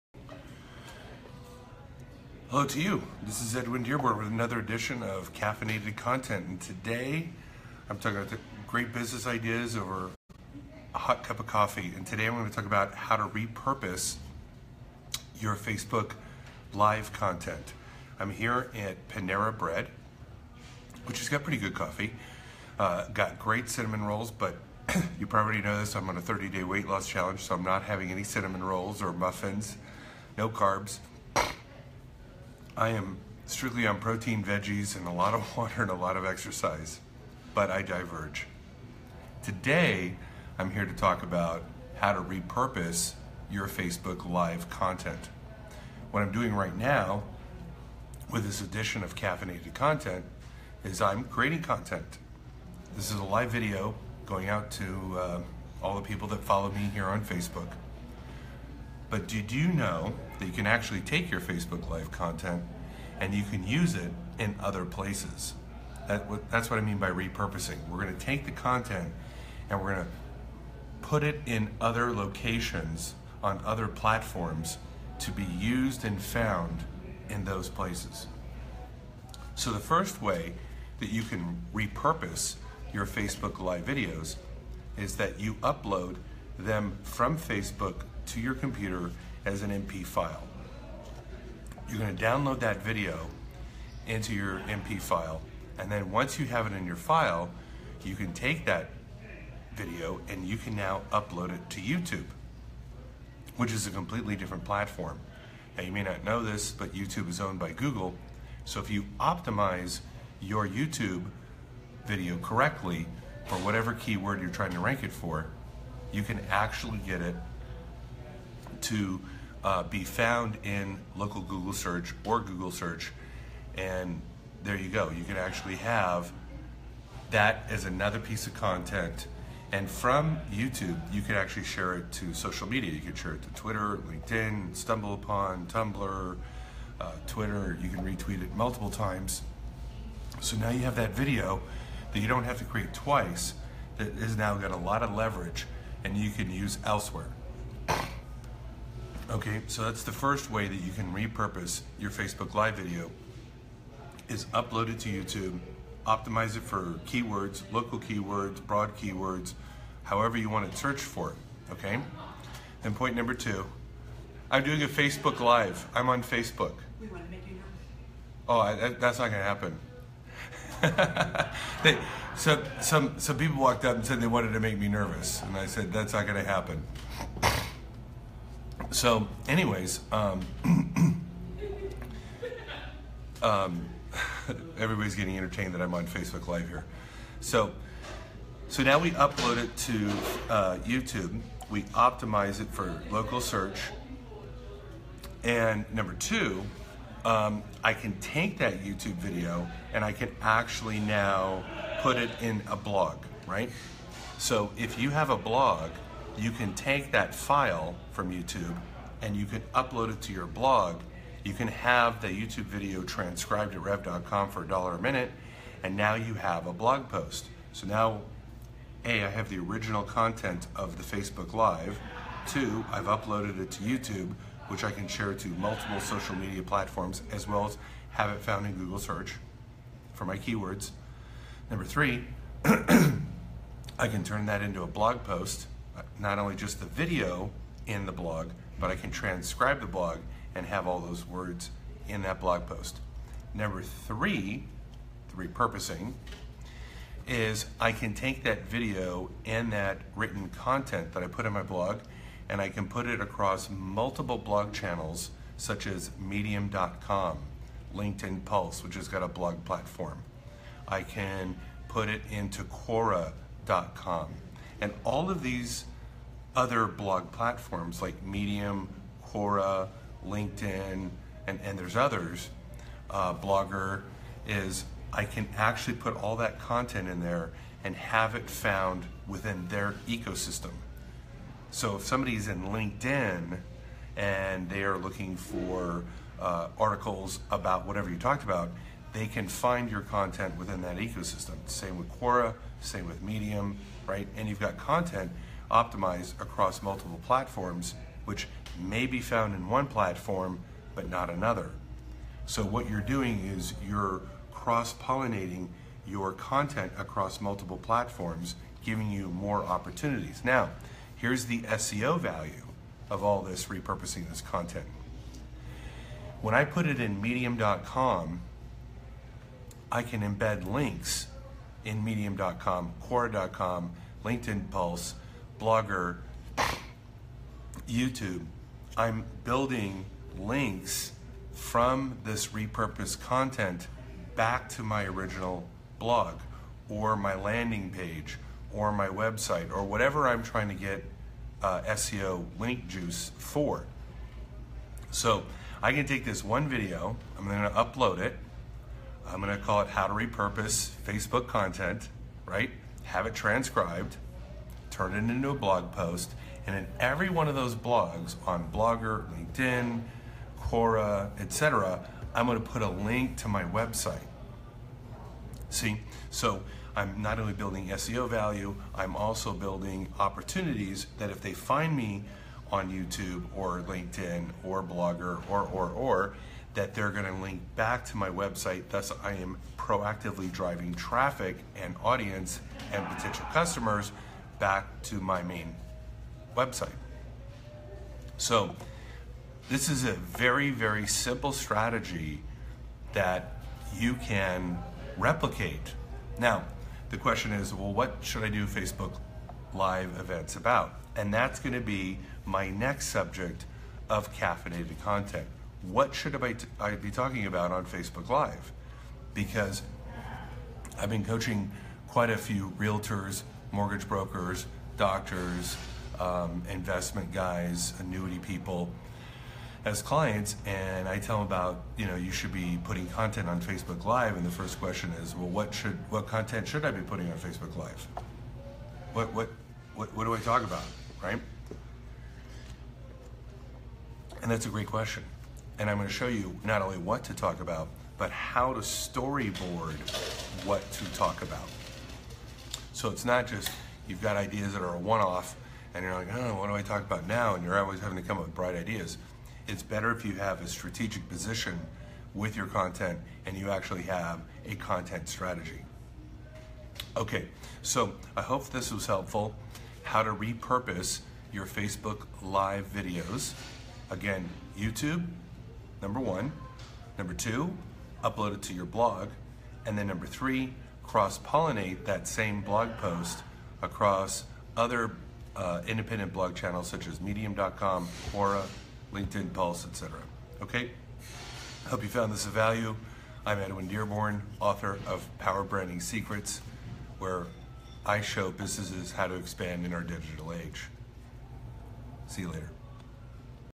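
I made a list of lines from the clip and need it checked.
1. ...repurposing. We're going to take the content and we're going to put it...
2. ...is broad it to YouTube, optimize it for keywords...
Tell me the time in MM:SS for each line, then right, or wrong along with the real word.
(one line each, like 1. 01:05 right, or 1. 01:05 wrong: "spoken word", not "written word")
1. 01:07 right
2. 02:34 wrong: "upload", not "broad".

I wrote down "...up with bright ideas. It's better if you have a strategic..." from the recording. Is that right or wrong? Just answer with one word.
right.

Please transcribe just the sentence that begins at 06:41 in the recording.
And that's going to be my next subject of caffeinated content.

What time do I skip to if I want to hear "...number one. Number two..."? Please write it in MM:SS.
07:46.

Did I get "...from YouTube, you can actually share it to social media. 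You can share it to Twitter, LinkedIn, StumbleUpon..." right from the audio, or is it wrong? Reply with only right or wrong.
right.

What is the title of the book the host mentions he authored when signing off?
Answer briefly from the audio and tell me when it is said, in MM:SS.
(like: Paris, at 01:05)
Power Branding Secrets, at 08:05.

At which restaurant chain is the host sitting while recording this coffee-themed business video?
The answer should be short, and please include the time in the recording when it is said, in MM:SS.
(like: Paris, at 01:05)
Panera Bread, at 00:19.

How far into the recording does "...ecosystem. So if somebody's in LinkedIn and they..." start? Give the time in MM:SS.
04:40.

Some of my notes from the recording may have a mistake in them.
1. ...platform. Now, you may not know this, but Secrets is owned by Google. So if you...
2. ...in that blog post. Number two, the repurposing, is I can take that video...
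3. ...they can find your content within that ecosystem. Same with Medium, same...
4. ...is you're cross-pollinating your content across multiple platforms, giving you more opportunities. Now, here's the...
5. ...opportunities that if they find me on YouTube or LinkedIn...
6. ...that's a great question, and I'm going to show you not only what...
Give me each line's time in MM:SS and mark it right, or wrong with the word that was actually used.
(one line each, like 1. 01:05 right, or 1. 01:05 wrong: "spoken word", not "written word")
1. 01:44 wrong: "YouTube", not "Secrets"
2. 04:02 wrong: "three", not "two"
3. 04:49 wrong: "Quora", not "Medium"
4. 05:03 right
5. 06:10 right
6. 07:14 right.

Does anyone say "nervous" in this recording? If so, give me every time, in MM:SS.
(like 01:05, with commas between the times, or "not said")
02:47, 02:54.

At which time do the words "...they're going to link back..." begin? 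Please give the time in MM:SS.
06:16.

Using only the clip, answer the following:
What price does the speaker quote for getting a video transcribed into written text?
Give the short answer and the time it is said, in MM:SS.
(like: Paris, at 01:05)
A dollar a minute, at 03:34.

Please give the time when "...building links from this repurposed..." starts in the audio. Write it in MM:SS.
05:29.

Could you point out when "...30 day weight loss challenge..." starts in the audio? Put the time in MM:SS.
00:26.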